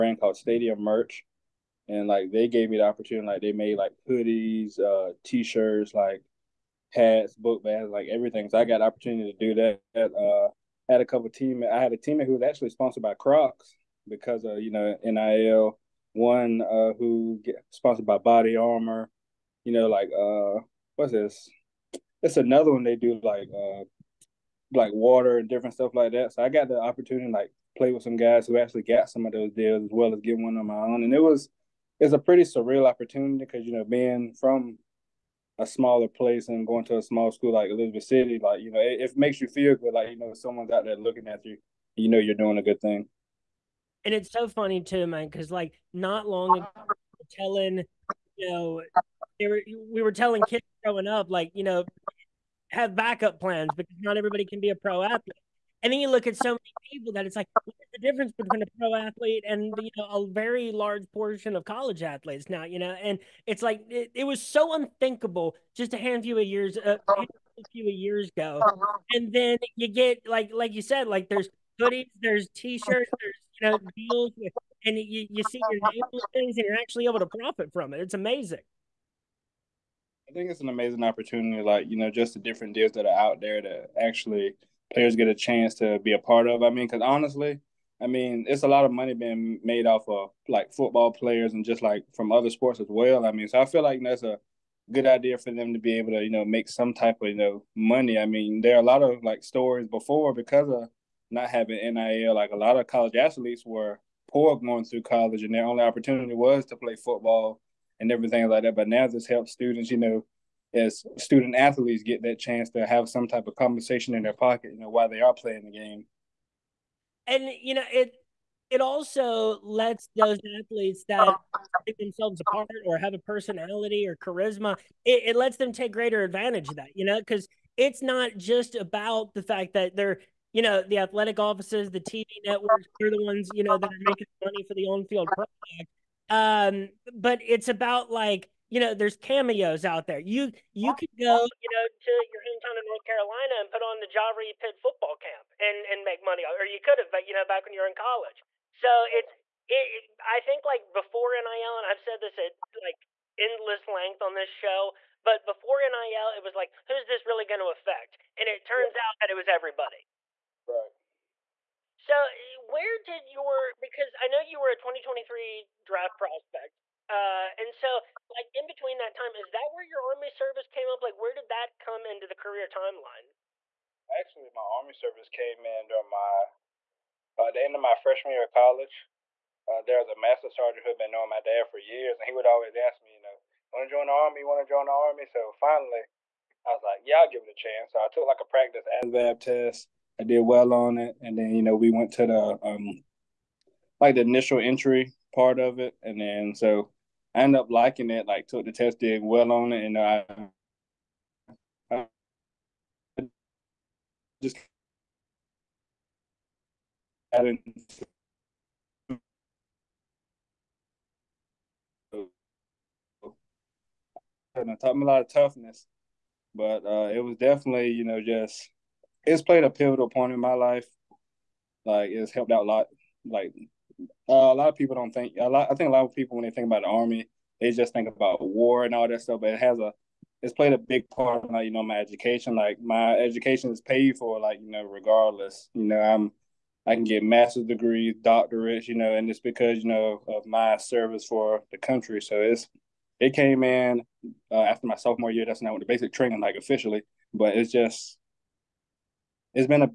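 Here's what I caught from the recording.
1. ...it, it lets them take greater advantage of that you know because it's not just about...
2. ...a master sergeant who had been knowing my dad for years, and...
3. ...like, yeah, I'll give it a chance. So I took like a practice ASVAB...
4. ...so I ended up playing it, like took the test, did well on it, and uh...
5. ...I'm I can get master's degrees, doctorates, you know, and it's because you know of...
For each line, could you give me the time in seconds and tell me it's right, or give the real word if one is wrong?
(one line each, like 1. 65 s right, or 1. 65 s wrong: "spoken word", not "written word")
1. 125 s right
2. 180 s right
3. 186 s right
4. 196 s wrong: "liking", not "playing"
5. 236 s right.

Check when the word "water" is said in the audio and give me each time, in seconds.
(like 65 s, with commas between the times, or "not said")
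24 s.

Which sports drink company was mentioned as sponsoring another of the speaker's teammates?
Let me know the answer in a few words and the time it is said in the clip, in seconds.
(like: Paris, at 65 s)
Body Armor, at 18 s.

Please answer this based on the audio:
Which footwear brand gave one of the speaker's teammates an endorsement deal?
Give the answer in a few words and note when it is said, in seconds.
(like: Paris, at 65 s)
Crocs, at 13 s.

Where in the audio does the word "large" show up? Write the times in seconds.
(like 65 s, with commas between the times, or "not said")
60 s.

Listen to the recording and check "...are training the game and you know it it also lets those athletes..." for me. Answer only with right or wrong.
wrong.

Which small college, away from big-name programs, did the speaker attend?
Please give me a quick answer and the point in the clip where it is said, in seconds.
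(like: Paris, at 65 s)
Elizabeth City, at 37 s.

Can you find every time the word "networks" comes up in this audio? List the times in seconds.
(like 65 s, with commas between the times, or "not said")
132 s.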